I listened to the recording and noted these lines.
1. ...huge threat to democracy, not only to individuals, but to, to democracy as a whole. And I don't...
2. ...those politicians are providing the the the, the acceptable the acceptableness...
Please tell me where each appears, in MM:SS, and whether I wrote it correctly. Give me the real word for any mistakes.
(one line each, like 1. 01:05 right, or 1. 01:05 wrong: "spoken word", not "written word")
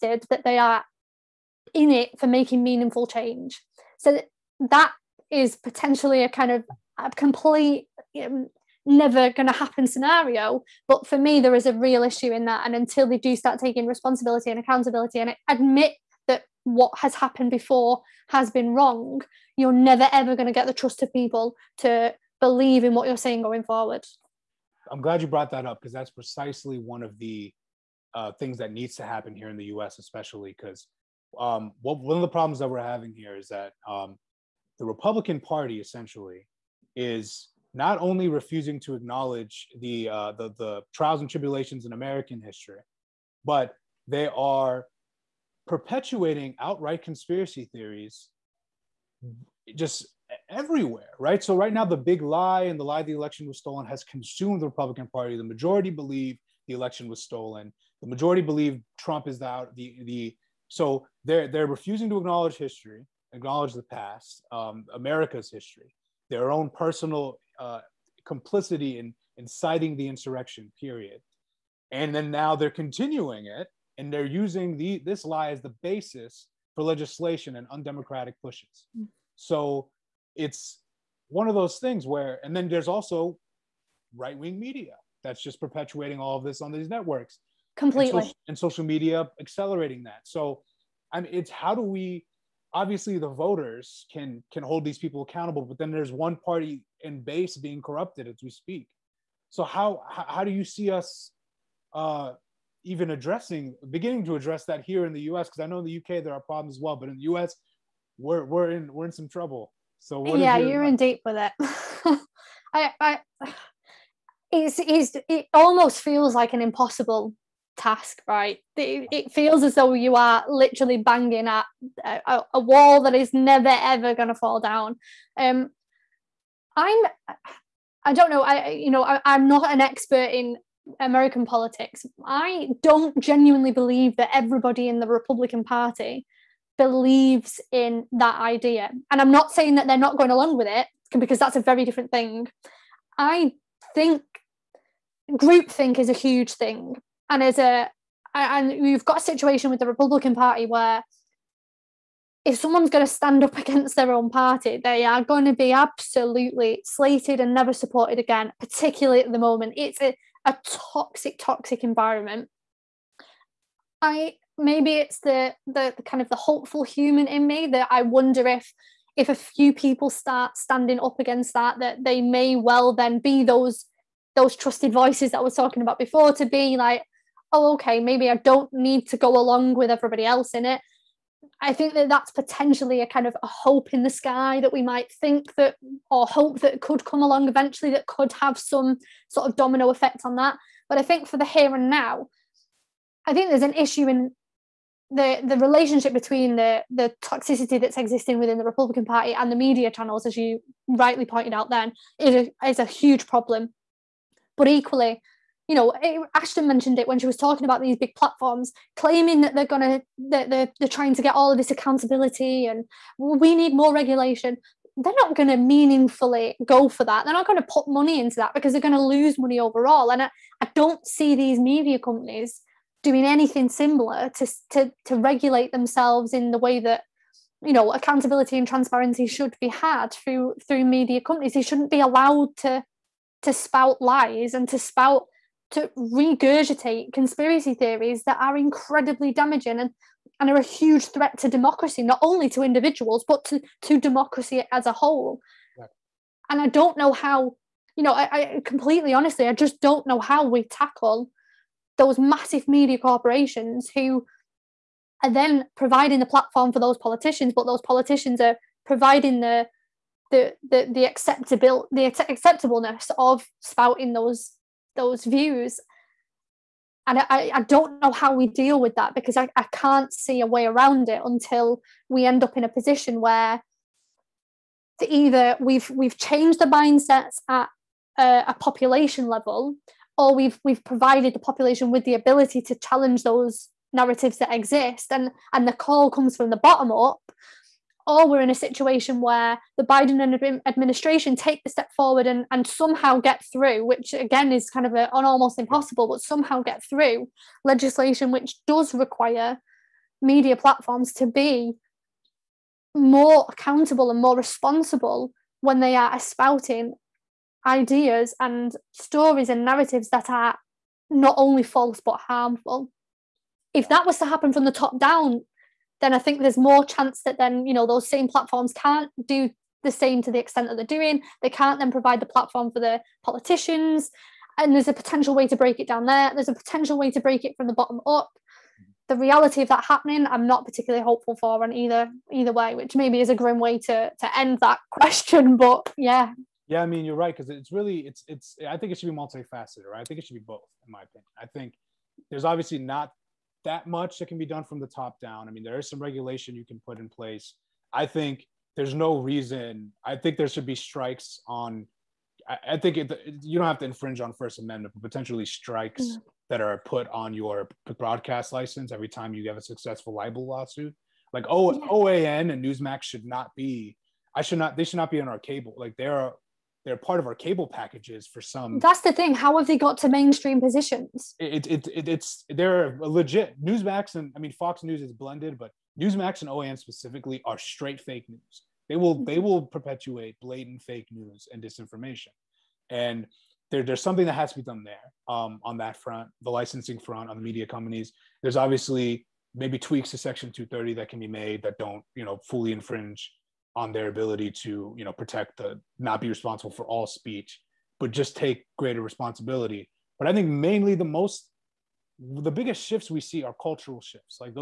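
1. 04:00 right
2. 04:17 right.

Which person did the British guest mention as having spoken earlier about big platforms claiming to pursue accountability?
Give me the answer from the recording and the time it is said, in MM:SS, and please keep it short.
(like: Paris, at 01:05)
Ashton, at 03:26.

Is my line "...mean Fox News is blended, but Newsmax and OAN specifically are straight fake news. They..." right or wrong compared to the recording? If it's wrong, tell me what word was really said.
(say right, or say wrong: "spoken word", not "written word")
right.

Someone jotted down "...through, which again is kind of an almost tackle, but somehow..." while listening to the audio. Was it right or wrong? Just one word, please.
wrong.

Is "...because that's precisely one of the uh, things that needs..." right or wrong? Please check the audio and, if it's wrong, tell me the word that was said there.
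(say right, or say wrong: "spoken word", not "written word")
right.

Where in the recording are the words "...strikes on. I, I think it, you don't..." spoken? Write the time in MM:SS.
05:50.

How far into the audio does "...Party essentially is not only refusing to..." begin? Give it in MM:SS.
00:35.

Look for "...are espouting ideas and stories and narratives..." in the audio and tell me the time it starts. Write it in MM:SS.
05:05.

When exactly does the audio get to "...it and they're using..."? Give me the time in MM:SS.
01:13.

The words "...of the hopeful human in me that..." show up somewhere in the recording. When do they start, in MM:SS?
02:46.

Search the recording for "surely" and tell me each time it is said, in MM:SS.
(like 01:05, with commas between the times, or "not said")
not said.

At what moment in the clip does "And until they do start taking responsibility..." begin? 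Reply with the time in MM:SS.
00:12.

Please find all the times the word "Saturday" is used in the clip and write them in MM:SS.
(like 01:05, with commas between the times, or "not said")
not said.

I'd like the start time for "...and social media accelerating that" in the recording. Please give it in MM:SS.
01:28.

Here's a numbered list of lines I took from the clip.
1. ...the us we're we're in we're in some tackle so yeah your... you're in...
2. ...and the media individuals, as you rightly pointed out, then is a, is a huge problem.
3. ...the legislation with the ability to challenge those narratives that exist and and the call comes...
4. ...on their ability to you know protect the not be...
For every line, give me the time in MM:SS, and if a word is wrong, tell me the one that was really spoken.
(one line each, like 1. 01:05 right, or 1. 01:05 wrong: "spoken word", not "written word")
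1. 01:47 wrong: "trouble", not "tackle"
2. 03:19 wrong: "channels", not "individuals"
3. 04:41 wrong: "population", not "legislation"
4. 06:33 right.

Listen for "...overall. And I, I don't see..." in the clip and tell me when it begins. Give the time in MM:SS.
03:39.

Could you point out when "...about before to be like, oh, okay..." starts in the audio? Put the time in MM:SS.
02:55.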